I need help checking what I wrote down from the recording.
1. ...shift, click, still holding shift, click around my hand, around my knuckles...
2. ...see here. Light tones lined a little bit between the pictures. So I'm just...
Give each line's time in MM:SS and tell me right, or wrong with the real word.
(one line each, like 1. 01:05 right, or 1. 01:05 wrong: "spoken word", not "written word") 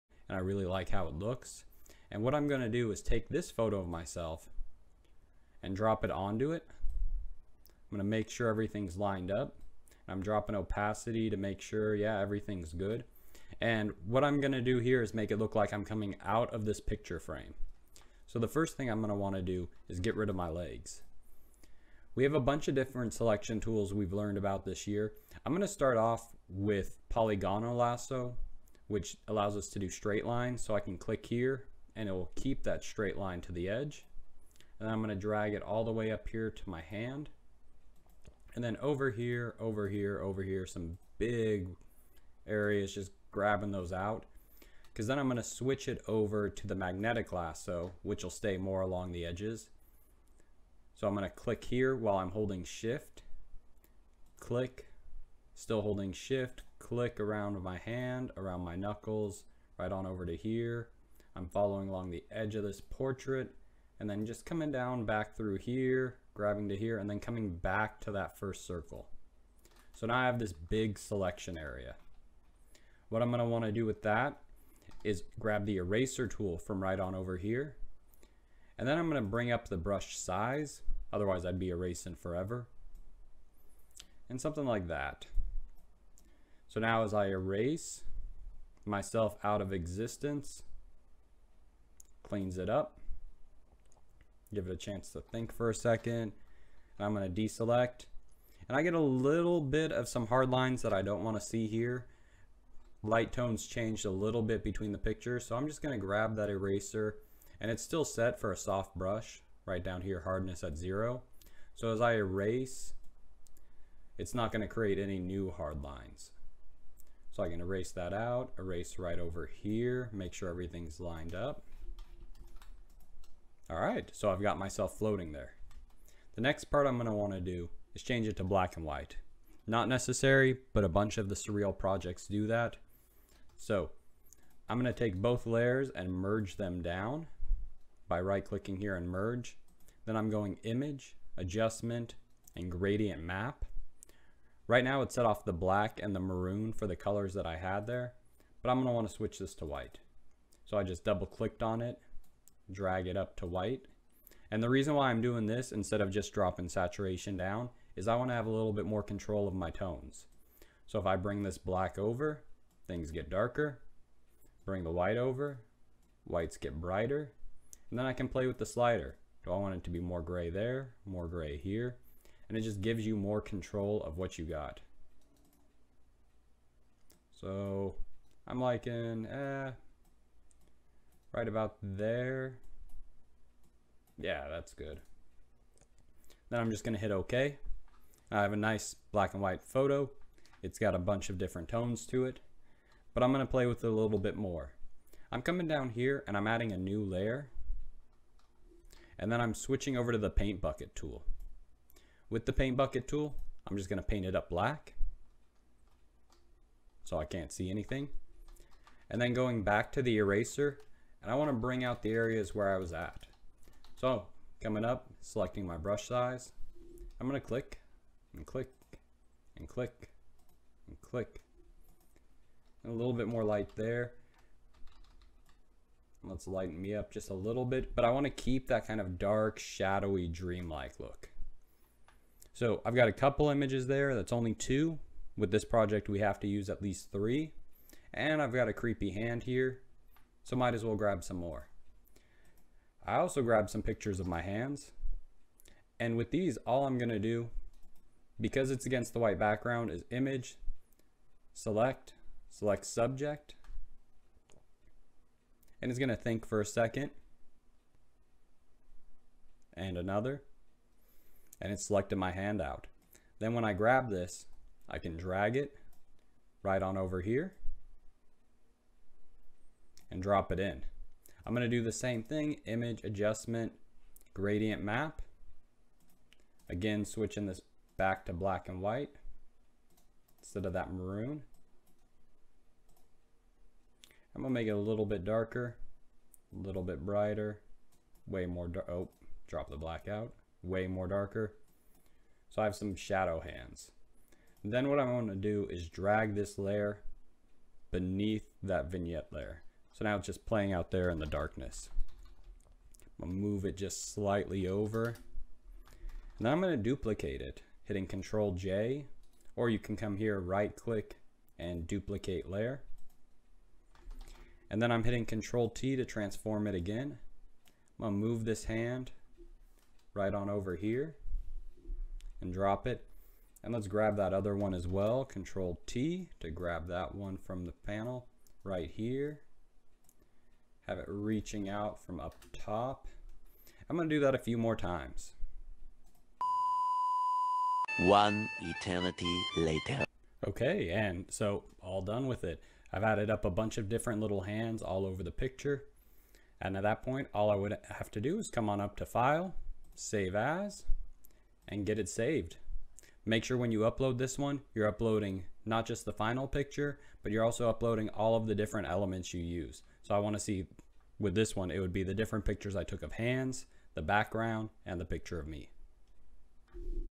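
1. 00:52 right
2. 01:41 wrong: "changed", not "lined".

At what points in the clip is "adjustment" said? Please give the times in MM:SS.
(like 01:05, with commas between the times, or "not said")
02:21, 04:33.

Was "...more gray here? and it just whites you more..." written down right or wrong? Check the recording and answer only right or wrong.
wrong.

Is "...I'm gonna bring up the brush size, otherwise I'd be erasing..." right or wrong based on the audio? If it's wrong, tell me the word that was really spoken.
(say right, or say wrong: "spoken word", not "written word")
right.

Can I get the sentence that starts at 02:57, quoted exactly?
So I'm liking eh, right about there.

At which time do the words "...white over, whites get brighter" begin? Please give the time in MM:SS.
02:44.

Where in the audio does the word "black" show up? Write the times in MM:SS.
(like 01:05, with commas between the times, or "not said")
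02:08, 02:25, 02:41, 03:09, 03:24, 04:38, 04:49.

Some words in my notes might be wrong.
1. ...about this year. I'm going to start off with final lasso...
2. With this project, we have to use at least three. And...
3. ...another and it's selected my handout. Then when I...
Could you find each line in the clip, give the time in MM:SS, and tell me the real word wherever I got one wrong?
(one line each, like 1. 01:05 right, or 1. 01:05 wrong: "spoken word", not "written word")
1. 00:24 wrong: "polygonal", not "final"
2. 03:55 right
3. 04:19 right.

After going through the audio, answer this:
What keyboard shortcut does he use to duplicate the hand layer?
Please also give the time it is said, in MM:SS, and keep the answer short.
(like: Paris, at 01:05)
Control J, at 05:08.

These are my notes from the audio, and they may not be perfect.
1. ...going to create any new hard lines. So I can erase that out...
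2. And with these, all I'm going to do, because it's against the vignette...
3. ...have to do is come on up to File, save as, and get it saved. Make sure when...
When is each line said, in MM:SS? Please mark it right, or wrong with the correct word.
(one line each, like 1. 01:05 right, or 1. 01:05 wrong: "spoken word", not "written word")
1. 01:54 right
2. 04:05 wrong: "white", not "vignette"
3. 05:47 right.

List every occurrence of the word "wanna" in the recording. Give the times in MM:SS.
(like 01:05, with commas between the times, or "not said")
01:13, 02:07, 02:28, 02:38, 03:31, 03:48, 06:00.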